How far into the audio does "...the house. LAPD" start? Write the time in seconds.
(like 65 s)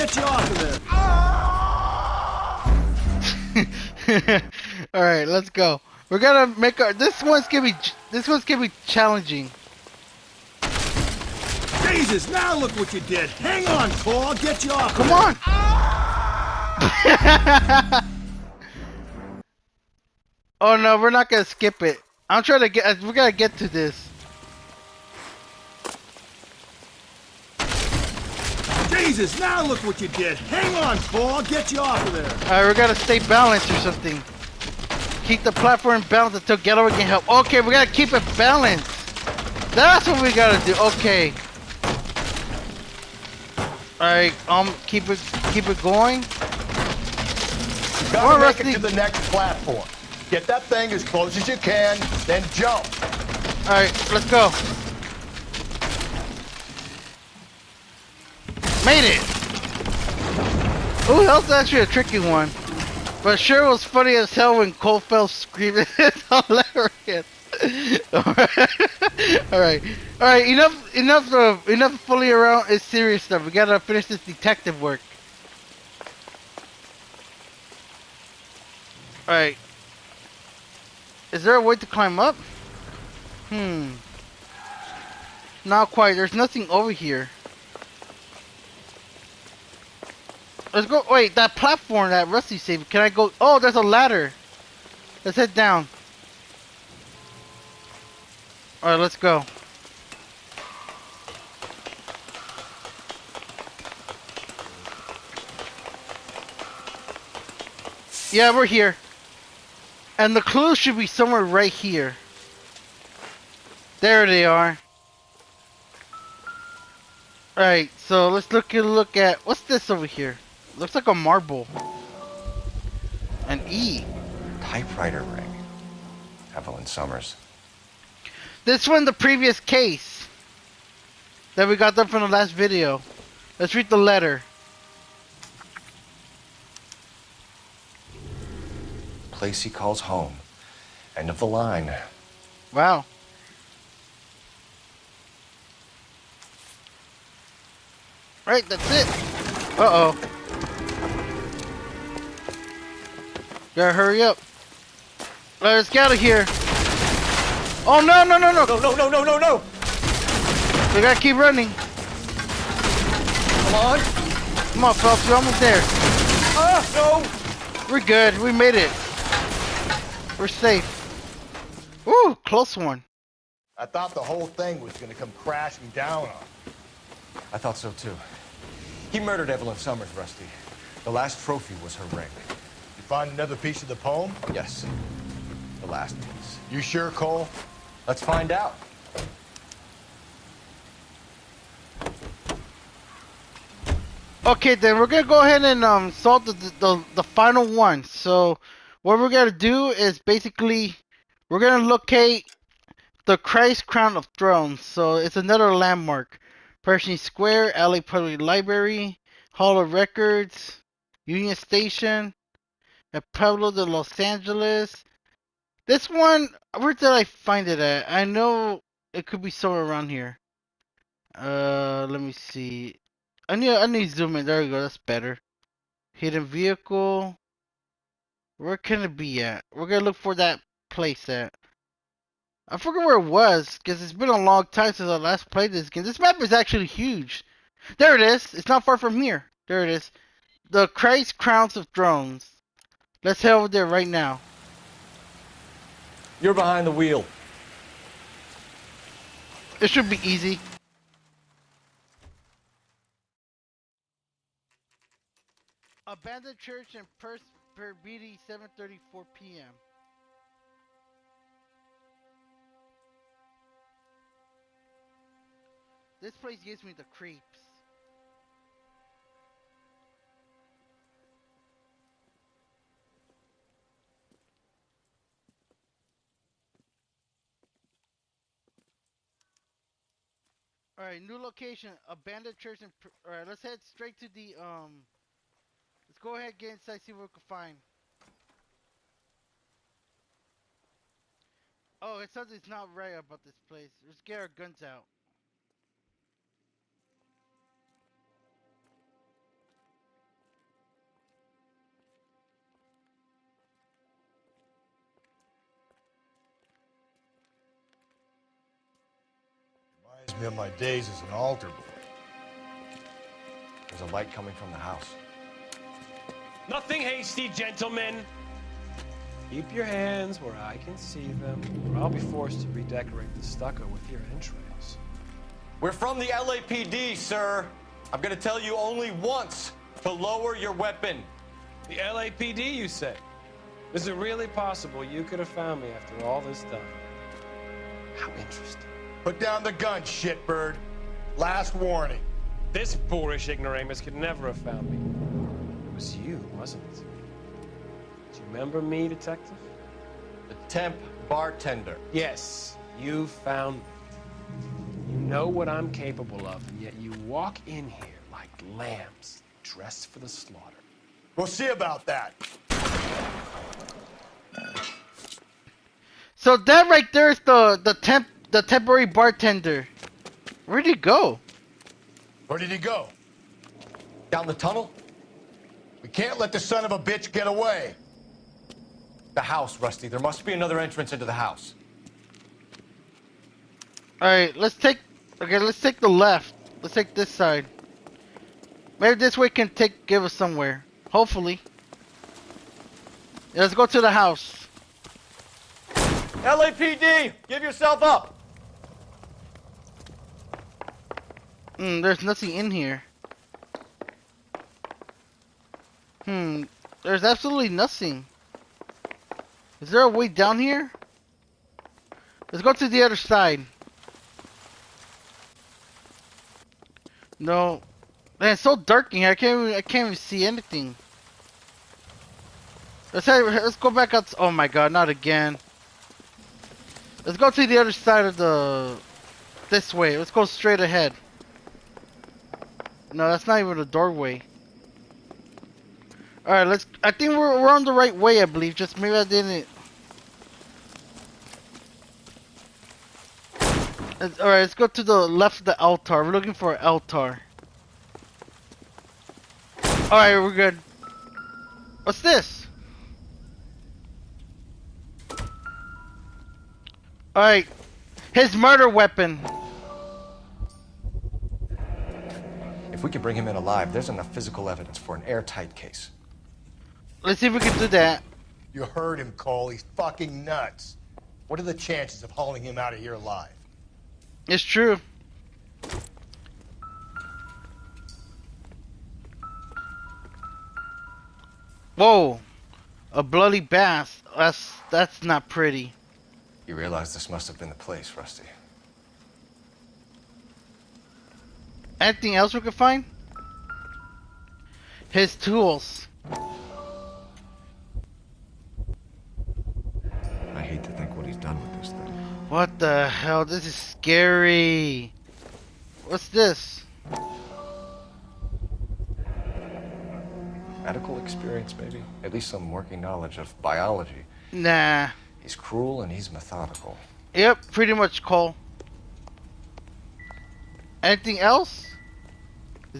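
394 s.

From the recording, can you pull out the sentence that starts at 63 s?
But sure was funny as hell when Cole fell screaming.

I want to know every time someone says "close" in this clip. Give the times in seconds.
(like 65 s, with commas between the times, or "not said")
51 s, 172 s.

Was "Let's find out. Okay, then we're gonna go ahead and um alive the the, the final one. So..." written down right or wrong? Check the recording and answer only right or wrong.
wrong.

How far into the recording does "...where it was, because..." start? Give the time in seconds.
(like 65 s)
233 s.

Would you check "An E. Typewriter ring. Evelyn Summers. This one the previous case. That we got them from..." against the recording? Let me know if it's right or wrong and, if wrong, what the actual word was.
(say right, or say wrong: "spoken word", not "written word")
right.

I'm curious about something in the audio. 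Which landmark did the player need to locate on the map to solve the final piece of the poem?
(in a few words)
The Christ Crown of Thrones.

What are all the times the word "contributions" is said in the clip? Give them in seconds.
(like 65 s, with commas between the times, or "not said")
not said.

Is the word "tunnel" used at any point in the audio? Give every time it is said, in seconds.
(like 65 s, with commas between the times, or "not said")
374 s.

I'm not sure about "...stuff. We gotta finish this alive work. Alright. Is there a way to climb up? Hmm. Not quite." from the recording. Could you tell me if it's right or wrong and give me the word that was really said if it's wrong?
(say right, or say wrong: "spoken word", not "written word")
wrong: "detective", not "alive".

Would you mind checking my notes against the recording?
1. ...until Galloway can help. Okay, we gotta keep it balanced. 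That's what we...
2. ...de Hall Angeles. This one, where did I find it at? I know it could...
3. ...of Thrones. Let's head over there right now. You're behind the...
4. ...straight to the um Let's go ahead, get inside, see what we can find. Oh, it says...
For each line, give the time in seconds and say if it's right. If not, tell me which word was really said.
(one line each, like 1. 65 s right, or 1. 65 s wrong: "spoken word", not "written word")
1. 36 s right
2. 213 s wrong: "Los", not "Hall"
3. 241 s right
4. 283 s right.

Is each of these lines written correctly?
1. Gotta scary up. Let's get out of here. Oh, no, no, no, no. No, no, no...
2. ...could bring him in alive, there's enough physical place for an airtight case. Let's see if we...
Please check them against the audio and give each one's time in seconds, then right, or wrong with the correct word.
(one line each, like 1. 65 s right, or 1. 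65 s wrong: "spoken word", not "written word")
1. 153 s wrong: "hurry", not "scary"
2. 463 s wrong: "evidence", not "place".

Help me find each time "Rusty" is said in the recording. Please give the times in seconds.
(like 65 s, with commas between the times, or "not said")
92 s, 180 s, 379 s, 488 s.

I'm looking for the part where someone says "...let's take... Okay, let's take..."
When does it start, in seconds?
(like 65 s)
384 s.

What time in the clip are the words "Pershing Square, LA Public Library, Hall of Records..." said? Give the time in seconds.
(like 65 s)
206 s.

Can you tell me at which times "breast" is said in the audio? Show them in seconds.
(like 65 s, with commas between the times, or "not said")
not said.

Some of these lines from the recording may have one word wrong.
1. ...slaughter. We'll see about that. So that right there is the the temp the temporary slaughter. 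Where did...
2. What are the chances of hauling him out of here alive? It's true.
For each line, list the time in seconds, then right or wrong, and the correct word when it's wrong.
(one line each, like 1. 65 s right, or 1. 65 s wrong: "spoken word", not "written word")
1. 360 s wrong: "bartender", not "slaughter"
2. 471 s right.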